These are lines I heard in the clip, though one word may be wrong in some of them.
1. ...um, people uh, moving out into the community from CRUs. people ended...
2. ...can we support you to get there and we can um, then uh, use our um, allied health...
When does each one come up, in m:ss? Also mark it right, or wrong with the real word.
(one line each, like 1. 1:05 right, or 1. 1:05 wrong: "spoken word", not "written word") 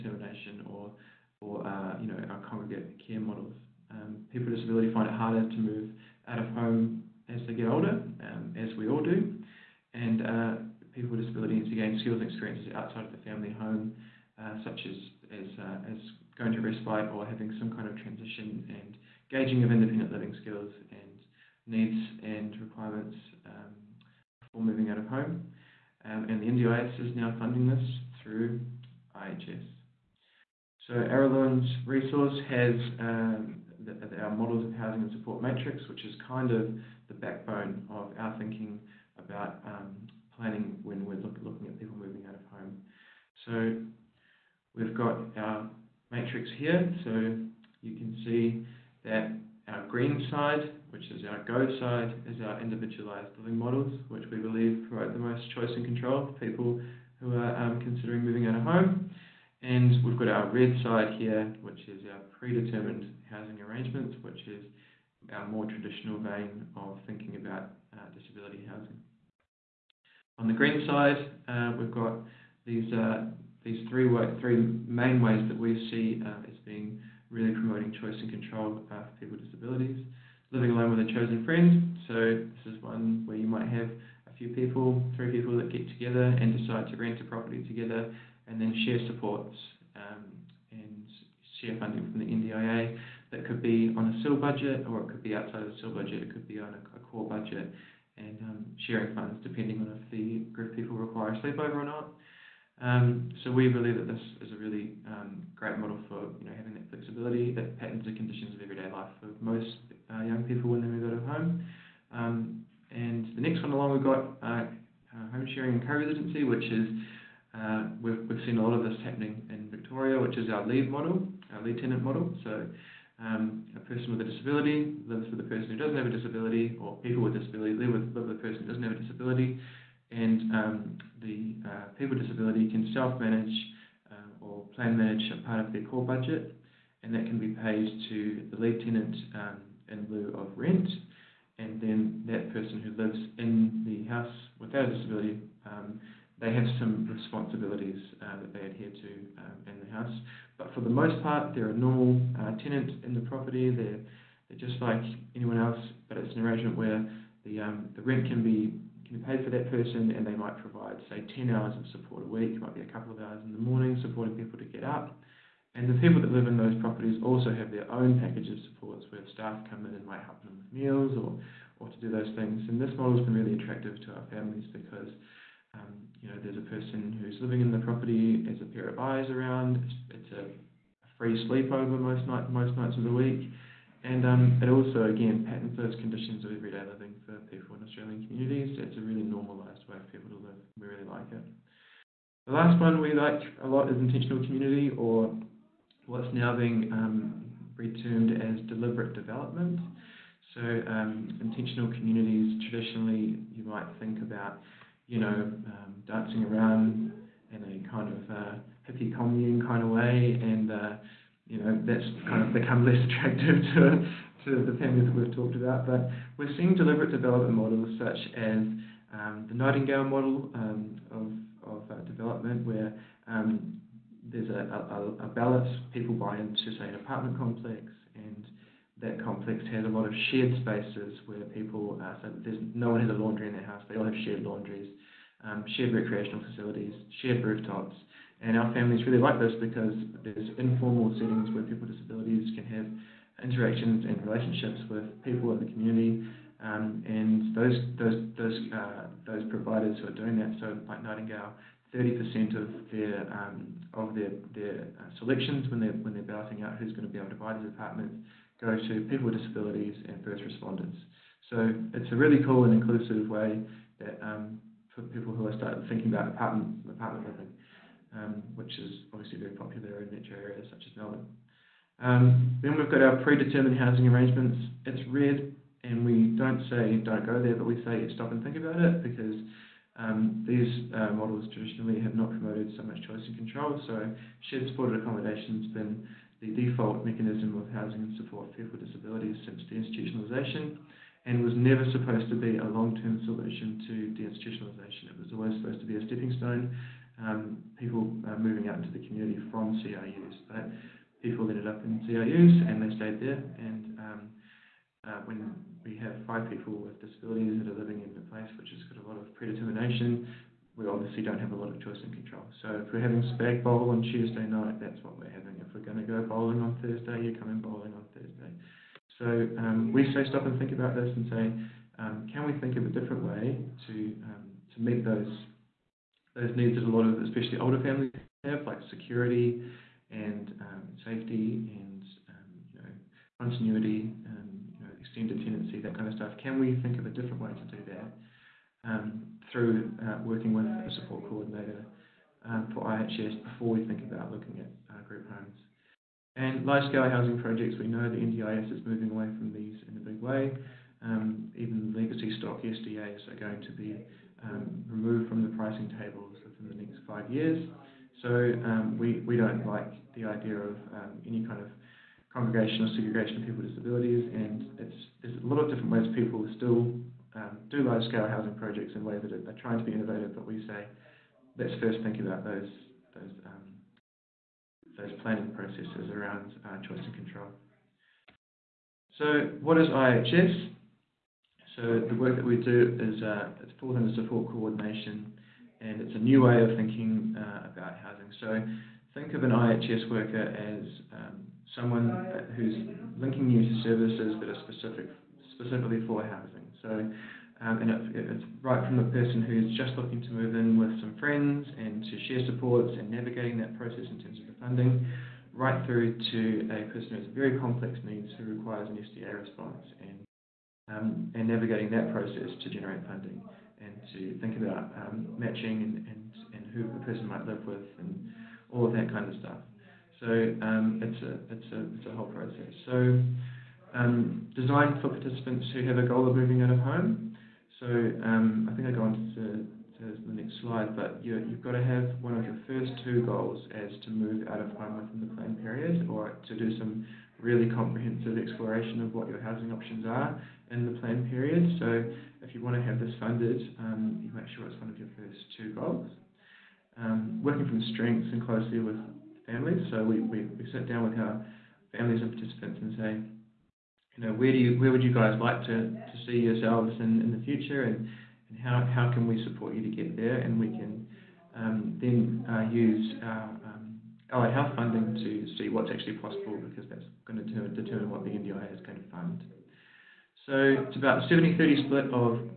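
1. 4:57 right
2. 7:39 right.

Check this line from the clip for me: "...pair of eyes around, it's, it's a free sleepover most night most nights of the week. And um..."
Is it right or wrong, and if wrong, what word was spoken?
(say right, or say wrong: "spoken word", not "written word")
right.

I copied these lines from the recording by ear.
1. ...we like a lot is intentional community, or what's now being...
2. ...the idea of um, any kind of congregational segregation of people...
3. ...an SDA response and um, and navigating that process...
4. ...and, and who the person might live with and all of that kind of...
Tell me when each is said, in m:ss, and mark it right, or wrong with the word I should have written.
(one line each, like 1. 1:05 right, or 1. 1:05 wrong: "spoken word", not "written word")
1. 3:13 right
2. 6:00 right
3. 6:48 right
4. 6:56 right.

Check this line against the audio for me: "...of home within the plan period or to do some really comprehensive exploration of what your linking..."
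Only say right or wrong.
wrong.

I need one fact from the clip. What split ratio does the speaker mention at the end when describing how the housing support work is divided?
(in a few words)
70-30.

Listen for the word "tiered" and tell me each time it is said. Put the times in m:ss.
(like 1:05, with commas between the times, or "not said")
not said.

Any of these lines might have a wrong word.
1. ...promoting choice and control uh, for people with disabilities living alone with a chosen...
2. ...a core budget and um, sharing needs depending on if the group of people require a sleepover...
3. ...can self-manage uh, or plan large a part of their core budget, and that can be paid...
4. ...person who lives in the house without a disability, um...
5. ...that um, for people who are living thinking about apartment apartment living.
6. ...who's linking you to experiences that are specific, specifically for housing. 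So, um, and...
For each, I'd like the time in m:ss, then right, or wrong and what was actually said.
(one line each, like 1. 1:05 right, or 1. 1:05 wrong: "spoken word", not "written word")
1. 1:17 right
2. 1:36 wrong: "funds", not "needs"
3. 2:12 wrong: "manage", not "large"
4. 2:22 right
5. 4:24 wrong: "starting", not "living"
6. 6:32 wrong: "services", not "experiences".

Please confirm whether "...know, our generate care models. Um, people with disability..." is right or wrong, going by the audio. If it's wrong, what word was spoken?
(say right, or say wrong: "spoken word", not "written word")
wrong: "congregate", not "generate".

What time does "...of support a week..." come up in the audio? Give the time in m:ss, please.
2:41.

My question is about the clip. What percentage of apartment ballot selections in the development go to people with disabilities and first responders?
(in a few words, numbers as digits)
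30%.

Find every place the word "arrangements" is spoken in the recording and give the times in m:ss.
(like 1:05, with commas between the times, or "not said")
1:03, 2:36, 4:34.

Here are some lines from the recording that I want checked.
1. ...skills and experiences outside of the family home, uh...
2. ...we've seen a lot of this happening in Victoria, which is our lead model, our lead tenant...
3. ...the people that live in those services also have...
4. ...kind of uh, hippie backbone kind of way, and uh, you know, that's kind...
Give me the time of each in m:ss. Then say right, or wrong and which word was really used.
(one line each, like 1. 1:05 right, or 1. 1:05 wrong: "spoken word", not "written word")
1. 0:12 right
2. 1:58 right
3. 2:45 wrong: "properties", not "services"
4. 3:27 wrong: "commune", not "backbone".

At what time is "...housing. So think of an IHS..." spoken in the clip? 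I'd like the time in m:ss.
6:27.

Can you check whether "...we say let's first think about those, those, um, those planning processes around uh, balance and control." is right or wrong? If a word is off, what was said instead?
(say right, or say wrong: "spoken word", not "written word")
wrong: "choice", not "balance".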